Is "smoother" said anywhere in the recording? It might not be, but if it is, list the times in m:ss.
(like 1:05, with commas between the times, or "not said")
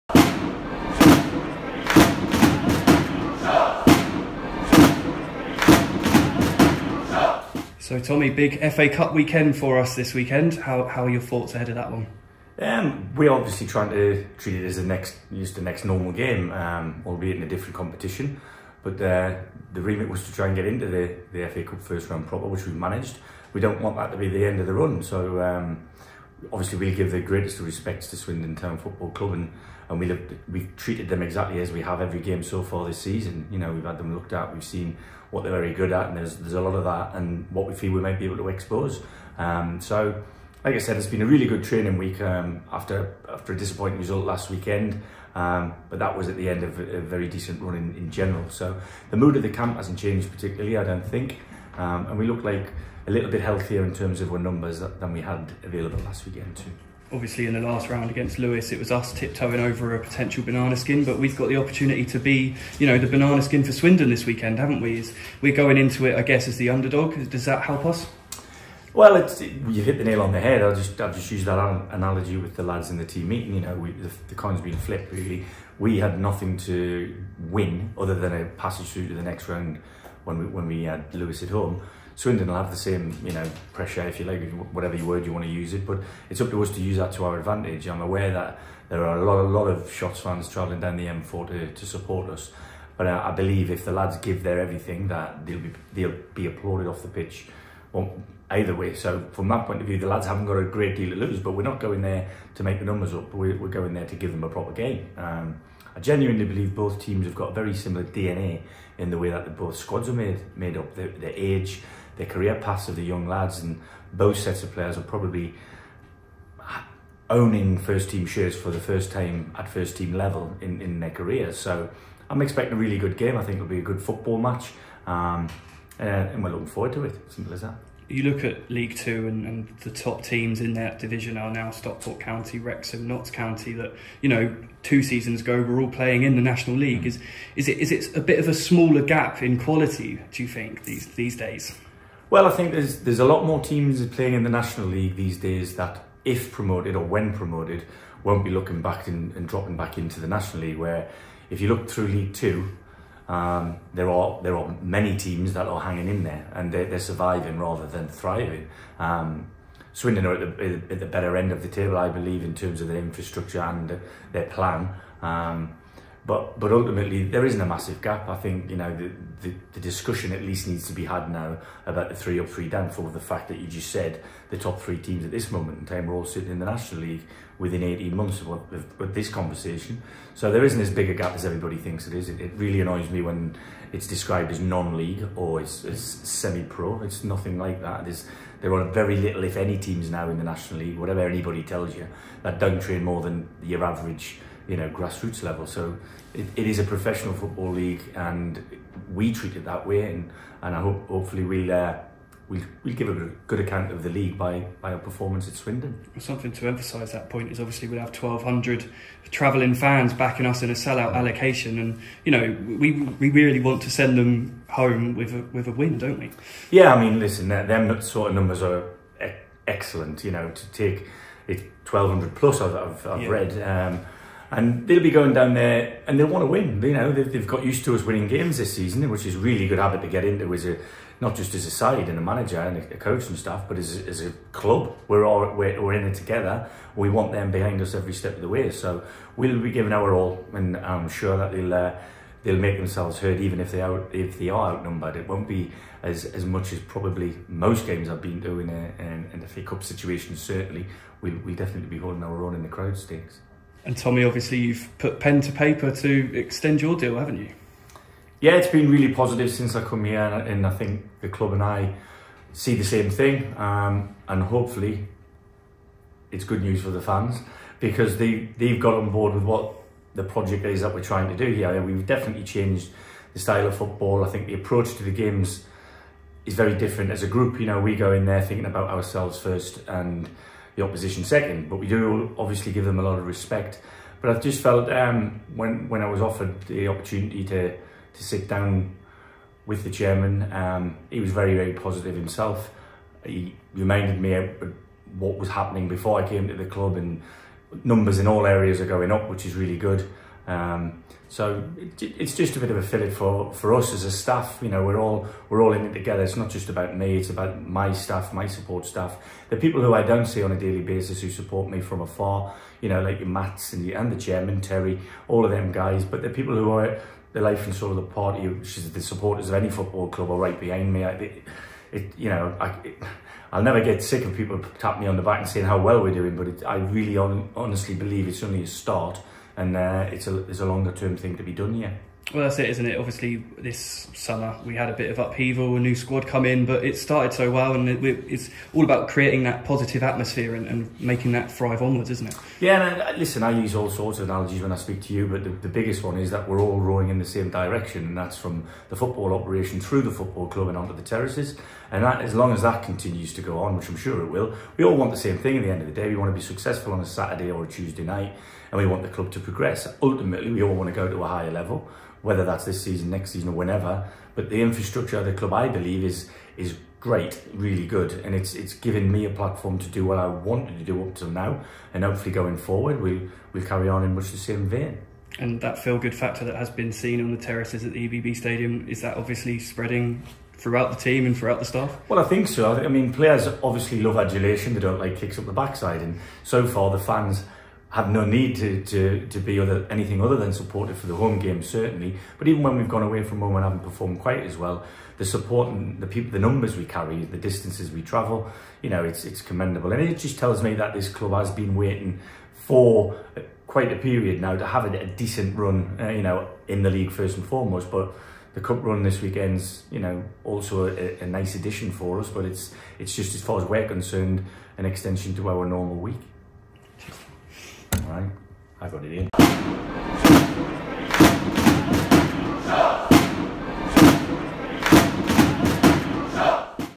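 not said.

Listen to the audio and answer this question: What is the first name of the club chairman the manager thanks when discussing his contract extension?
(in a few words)
Terry.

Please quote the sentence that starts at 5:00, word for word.
Um, so it, it's just a bit of a fillip for, for us as a staff.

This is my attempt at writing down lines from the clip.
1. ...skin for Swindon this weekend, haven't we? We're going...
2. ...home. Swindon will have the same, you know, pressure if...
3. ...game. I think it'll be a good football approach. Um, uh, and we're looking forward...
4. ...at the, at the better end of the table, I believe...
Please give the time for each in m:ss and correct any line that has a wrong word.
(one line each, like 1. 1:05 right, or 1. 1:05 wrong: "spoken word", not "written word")
1. 1:03 right
2. 1:21 right
3. 2:03 wrong: "match", not "approach"
4. 2:40 right.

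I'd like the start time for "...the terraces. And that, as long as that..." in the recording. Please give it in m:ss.
5:50.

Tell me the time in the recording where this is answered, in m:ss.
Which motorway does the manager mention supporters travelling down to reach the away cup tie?
1:31.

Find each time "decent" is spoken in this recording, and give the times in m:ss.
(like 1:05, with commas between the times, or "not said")
0:47, 6:45.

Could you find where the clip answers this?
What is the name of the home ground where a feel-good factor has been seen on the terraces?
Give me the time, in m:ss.
6:18.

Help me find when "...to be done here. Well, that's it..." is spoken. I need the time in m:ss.
5:31.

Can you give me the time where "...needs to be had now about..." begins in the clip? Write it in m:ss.
2:50.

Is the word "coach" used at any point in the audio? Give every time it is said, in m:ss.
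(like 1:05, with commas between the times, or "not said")
3:52.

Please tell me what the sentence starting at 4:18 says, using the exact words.
Yeah, it's been really positive since I come here, and, I think the club and I see the same thing.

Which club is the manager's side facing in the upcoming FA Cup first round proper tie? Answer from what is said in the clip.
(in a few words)
Swindon Town.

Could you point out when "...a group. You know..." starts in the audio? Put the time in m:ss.
4:37.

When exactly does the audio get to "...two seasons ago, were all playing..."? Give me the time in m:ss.
2:14.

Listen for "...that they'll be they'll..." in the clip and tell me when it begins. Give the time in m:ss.
1:35.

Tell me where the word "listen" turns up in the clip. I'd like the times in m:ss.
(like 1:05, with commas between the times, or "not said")
3:37, 5:43.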